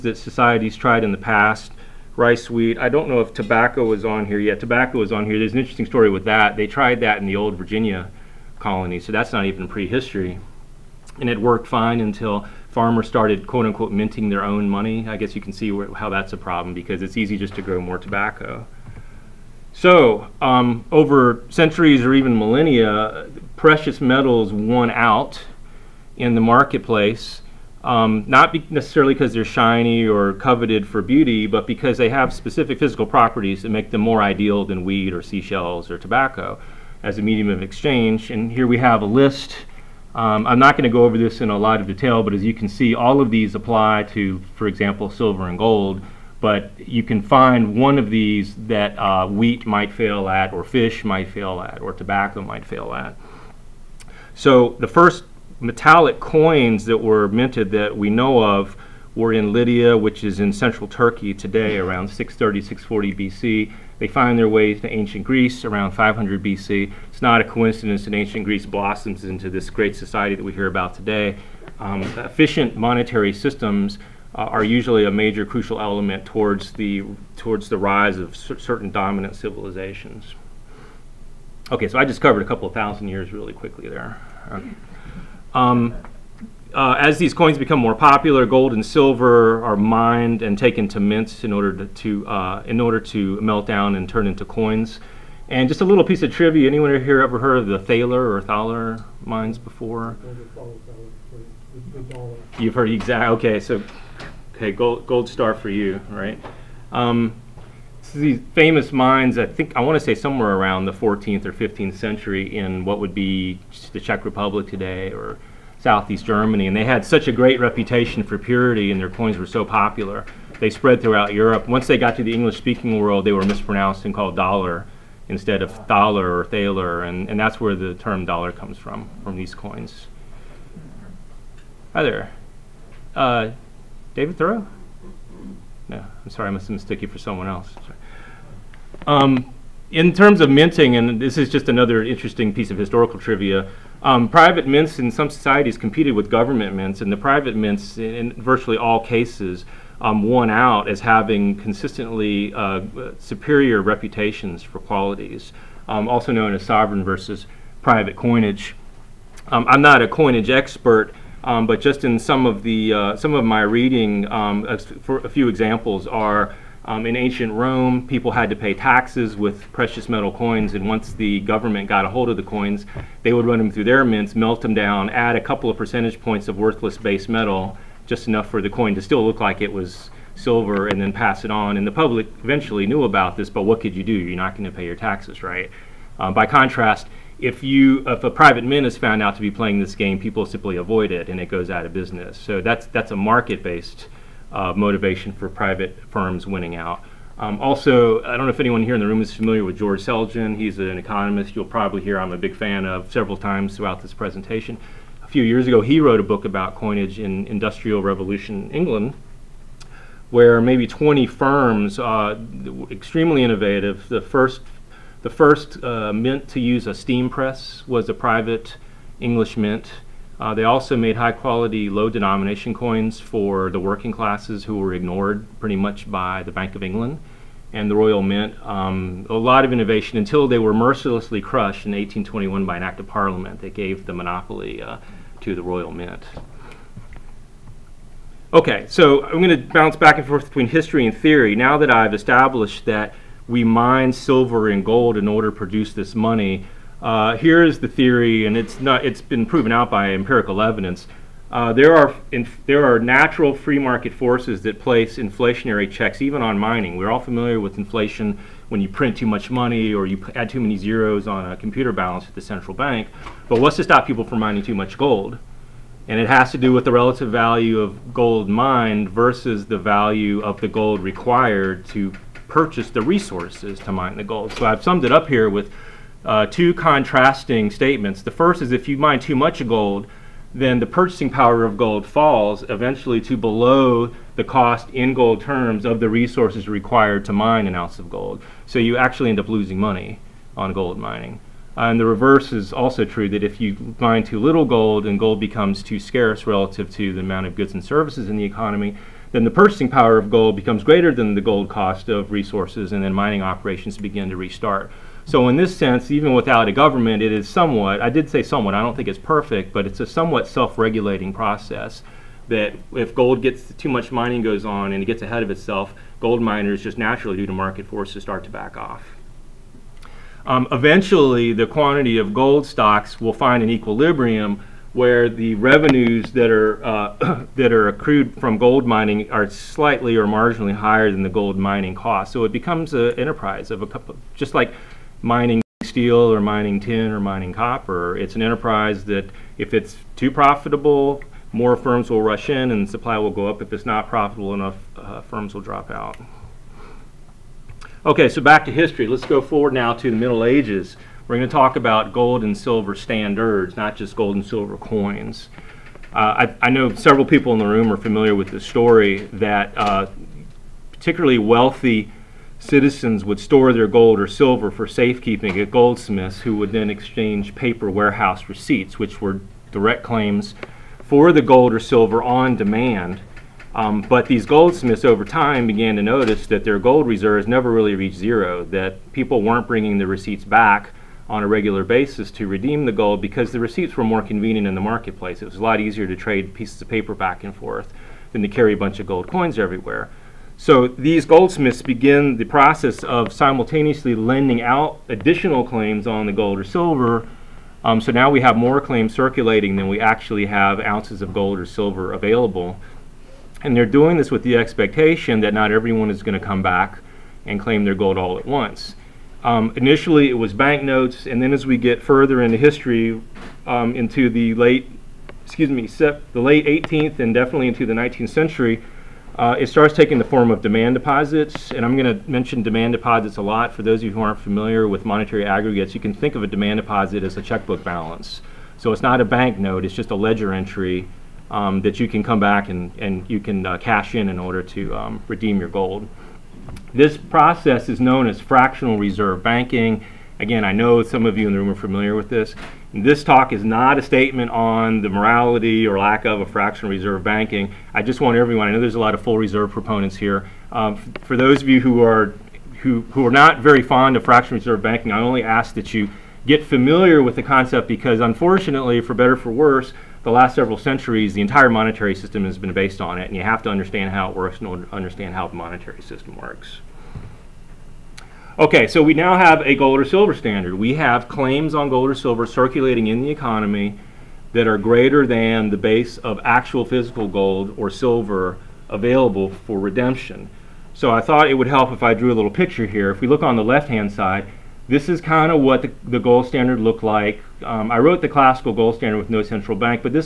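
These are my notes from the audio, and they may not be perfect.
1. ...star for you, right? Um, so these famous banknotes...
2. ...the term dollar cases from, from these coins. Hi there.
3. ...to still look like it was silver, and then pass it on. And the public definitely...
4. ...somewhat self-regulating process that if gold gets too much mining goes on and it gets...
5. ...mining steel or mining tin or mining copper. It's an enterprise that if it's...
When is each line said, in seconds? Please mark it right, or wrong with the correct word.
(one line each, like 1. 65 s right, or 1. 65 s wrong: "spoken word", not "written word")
1. 105 s wrong: "mines", not "banknotes"
2. 127 s wrong: "comes", not "cases"
3. 178 s wrong: "eventually", not "definitely"
4. 310 s right
5. 335 s right.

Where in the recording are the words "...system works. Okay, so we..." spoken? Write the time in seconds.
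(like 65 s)
466 s.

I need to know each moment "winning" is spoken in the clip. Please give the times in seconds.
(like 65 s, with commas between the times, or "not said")
196 s.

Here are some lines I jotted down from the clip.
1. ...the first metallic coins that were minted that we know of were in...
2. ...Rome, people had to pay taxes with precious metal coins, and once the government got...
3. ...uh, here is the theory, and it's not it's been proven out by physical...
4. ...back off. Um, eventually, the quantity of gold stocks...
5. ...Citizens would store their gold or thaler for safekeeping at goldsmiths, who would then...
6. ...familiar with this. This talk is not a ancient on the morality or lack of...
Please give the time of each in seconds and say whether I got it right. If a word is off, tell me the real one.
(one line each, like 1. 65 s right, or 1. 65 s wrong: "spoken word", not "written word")
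1. 54 s right
2. 167 s right
3. 247 s wrong: "empirical", not "physical"
4. 318 s right
5. 362 s wrong: "silver", not "thaler"
6. 441 s wrong: "statement", not "ancient".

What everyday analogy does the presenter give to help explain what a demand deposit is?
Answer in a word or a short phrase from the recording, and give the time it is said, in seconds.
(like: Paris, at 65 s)
checkbook balance, at 427 s.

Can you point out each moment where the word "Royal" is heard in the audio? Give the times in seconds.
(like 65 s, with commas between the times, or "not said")
227 s, 235 s.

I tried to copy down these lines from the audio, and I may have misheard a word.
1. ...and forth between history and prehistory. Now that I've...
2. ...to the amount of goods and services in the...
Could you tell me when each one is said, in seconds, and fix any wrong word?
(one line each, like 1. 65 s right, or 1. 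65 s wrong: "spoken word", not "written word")
1. 240 s wrong: "theory", not "prehistory"
2. 296 s right.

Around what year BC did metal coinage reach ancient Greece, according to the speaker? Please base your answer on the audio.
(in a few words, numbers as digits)
500 BC.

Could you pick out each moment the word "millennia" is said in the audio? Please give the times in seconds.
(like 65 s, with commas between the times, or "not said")
22 s.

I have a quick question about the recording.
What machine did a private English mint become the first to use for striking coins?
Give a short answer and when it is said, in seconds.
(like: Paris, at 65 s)
steam press, at 216 s.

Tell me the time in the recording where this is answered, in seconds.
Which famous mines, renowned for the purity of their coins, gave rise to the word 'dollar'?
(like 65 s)
98 s.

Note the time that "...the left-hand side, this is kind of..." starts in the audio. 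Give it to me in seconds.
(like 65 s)
483 s.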